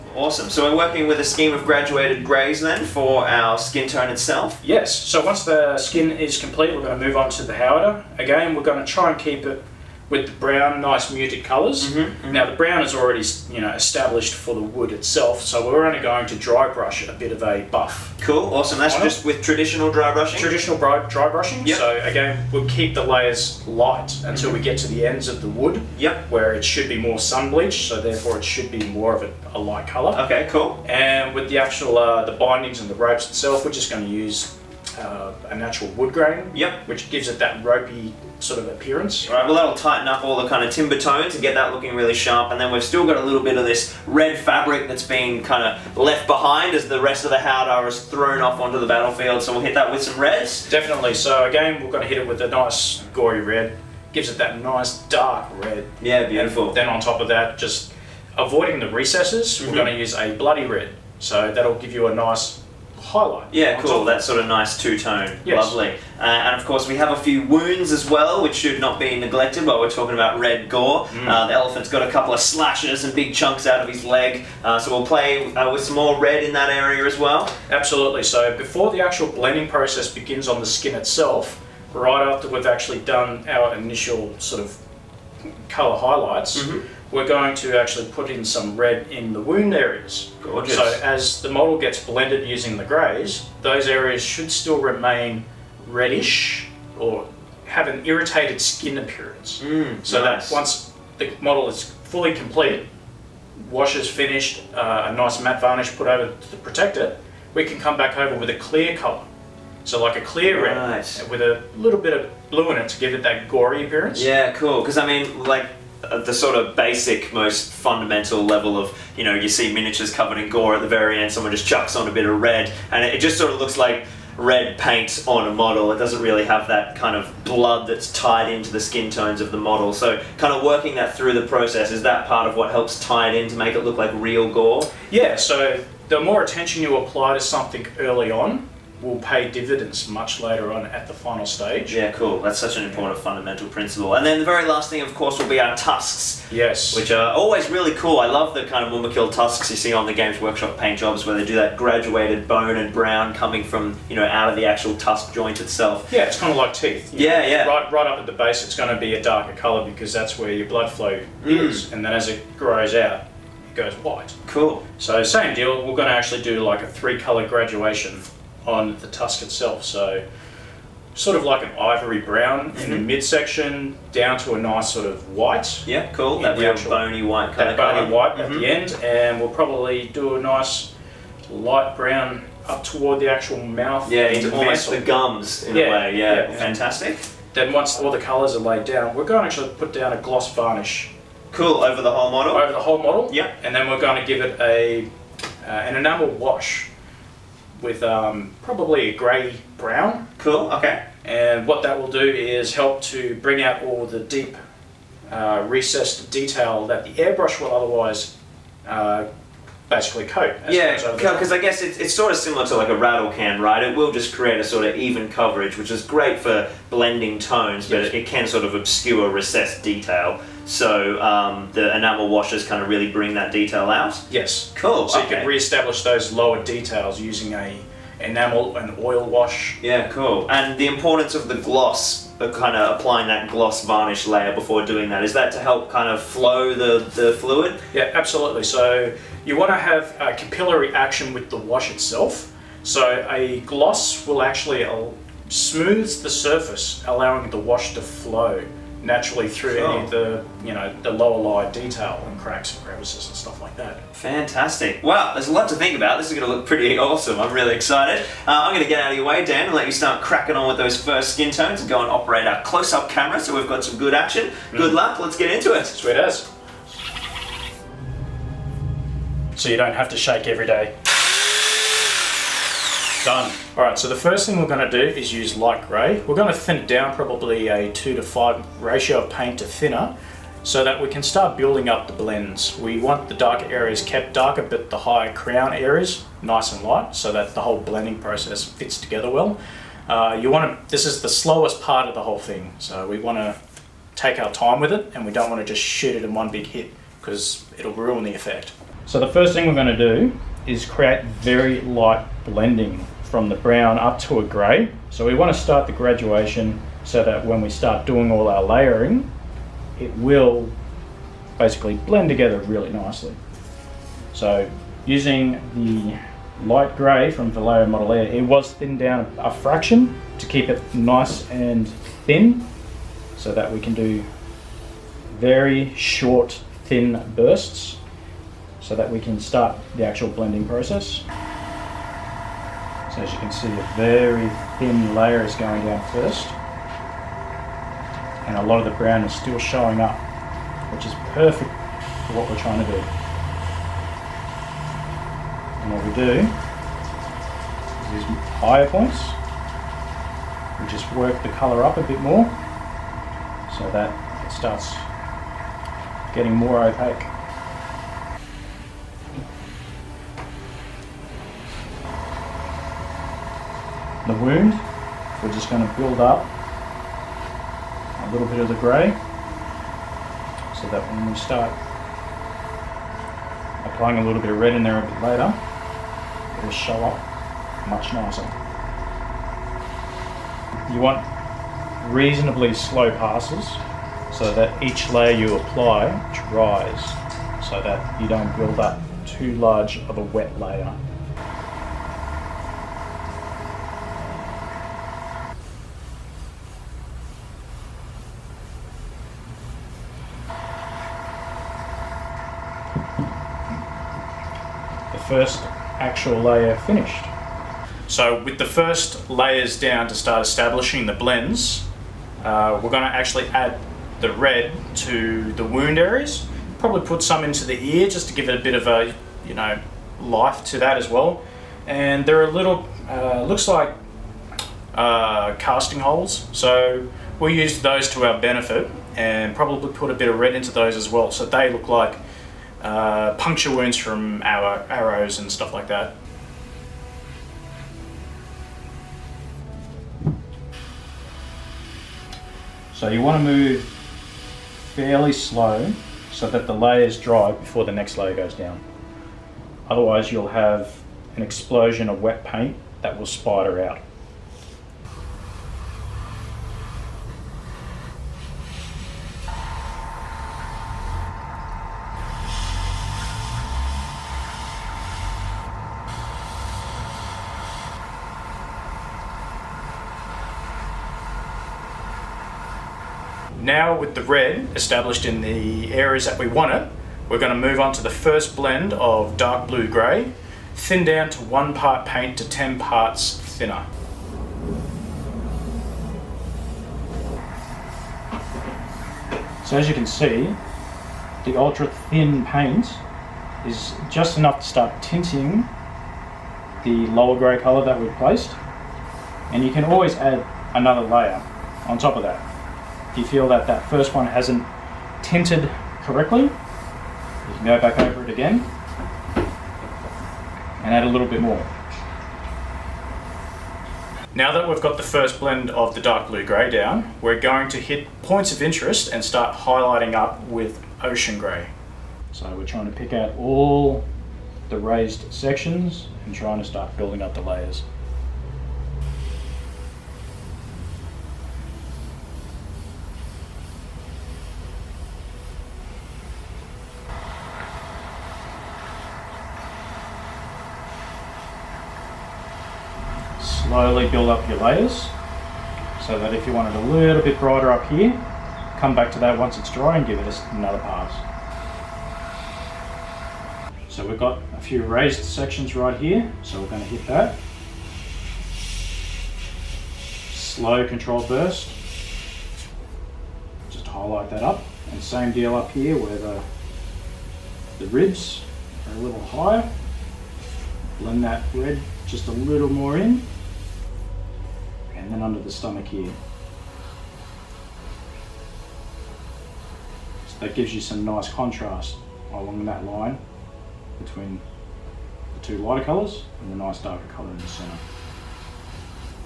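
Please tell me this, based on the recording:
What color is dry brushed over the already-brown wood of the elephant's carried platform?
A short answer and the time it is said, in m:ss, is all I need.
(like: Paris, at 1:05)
Buff, at 0:17.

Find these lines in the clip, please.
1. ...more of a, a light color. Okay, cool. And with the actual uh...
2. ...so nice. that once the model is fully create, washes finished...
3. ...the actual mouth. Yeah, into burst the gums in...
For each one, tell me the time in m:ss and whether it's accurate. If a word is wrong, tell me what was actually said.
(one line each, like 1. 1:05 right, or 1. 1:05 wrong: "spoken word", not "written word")
1. 0:28 right
2. 1:40 wrong: "complete", not "create"
3. 3:03 wrong: "almost", not "burst".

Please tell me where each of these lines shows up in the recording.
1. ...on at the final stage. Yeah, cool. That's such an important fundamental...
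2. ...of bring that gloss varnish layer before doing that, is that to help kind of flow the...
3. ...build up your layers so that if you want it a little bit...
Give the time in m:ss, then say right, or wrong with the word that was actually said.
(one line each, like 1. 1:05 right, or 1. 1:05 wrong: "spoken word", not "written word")
1. 2:20 right
2. 3:52 wrong: "applying", not "bring"
3. 9:04 right.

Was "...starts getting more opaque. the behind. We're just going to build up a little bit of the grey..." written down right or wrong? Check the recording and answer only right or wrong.
wrong.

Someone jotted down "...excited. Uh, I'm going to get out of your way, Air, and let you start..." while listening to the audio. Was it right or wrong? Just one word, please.
wrong.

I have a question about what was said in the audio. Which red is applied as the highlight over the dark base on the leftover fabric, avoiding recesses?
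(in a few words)
Bloody red.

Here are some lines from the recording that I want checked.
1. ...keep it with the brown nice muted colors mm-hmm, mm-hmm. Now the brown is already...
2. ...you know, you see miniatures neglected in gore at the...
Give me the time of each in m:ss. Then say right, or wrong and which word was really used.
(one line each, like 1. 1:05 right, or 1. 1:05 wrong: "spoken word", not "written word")
1. 0:09 right
2. 1:59 wrong: "covered", not "neglected".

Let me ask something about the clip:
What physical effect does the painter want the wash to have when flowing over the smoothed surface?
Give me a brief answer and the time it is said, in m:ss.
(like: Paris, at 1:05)
Capillary action, at 4:00.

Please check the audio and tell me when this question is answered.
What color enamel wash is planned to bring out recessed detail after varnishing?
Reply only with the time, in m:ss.
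3:19.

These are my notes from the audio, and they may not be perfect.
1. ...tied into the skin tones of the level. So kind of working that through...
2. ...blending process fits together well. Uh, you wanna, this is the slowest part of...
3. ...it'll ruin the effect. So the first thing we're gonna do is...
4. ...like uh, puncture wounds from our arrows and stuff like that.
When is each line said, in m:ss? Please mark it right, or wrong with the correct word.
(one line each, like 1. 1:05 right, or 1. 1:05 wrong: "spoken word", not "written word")
1. 2:08 wrong: "model", not "level"
2. 4:47 right
3. 4:57 right
4. 7:11 right.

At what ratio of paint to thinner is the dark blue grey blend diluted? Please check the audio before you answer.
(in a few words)
1 to 10.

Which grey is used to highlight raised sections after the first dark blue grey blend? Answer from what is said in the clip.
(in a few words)
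Ocean grey.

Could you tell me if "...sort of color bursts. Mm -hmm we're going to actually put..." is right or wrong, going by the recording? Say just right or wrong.
wrong.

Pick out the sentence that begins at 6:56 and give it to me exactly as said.
Probably put some into the ear just to give it a bit of a, you know, life to that as well.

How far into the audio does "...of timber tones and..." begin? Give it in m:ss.
0:40.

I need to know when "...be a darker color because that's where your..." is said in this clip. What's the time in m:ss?
2:38.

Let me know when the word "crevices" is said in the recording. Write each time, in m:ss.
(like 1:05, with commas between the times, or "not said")
4:12.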